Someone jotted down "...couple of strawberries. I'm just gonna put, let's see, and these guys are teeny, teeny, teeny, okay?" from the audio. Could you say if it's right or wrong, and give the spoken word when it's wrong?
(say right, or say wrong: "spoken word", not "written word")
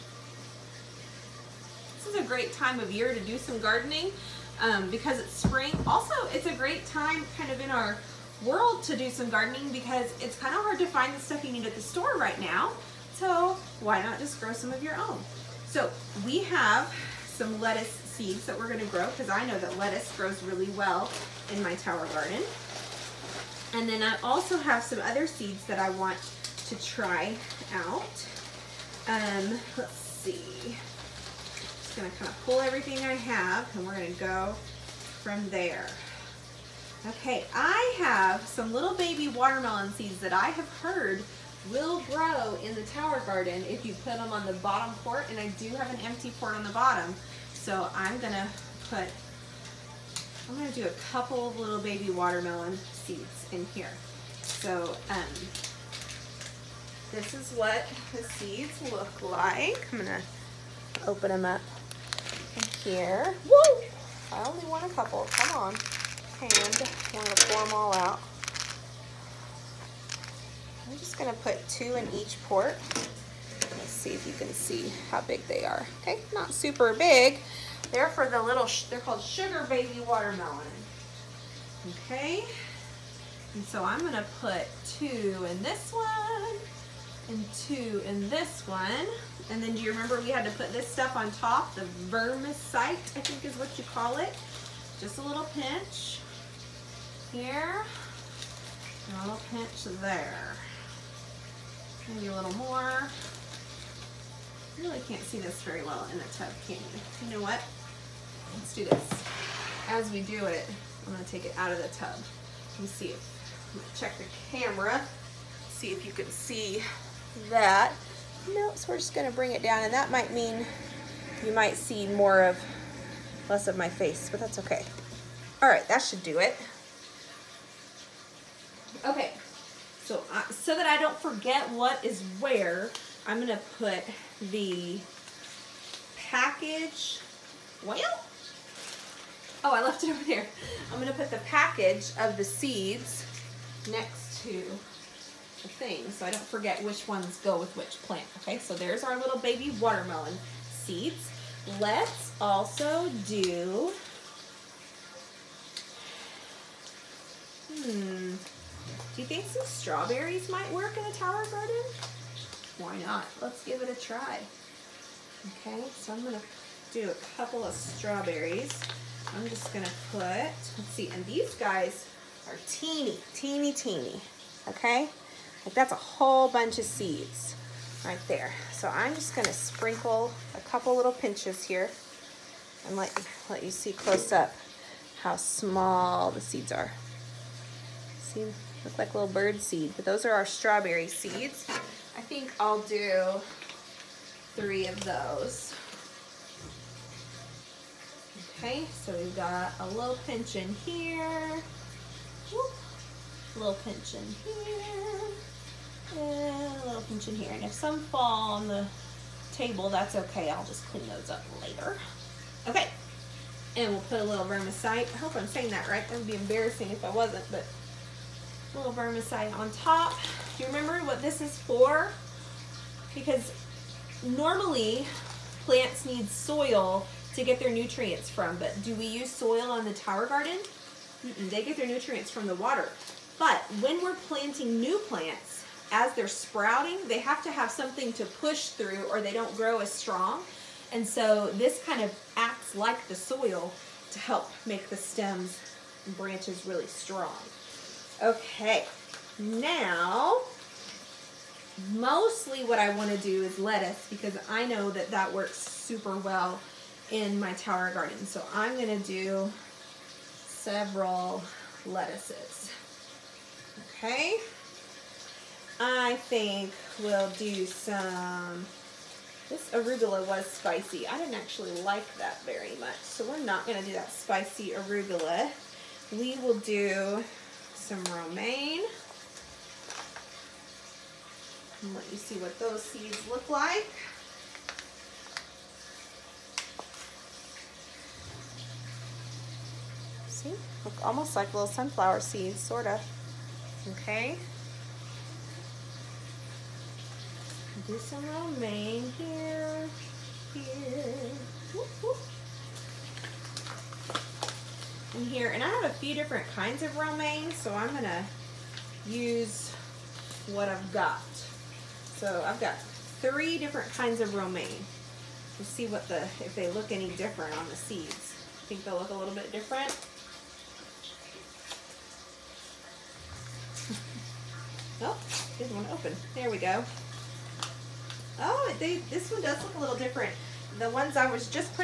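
right.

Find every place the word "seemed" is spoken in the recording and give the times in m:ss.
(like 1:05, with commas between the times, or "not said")
not said.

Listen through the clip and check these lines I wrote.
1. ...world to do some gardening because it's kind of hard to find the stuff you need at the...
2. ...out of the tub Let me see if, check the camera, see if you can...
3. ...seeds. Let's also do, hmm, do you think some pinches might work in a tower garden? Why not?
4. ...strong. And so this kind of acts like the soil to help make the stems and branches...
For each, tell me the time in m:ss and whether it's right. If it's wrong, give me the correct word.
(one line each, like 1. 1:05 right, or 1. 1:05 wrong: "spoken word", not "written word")
1. 0:08 right
2. 1:51 right
3. 2:30 wrong: "strawberries", not "pinches"
4. 3:59 right.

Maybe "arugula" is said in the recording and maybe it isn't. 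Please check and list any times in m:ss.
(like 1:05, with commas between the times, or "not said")
4:29, 4:34.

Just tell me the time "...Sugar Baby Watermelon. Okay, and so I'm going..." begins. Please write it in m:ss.
1:19.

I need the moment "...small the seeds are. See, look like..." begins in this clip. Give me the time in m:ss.
3:05.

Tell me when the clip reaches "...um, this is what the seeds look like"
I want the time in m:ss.
0:55.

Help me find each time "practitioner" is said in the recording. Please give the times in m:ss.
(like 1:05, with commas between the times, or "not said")
not said.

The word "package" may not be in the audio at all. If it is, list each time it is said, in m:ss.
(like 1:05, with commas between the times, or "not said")
2:16, 2:21.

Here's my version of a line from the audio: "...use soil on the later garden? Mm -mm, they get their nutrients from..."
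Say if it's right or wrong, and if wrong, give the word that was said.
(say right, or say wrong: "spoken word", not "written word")
wrong: "tower", not "later".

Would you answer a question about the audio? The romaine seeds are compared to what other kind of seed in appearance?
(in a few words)
sunflower seeds.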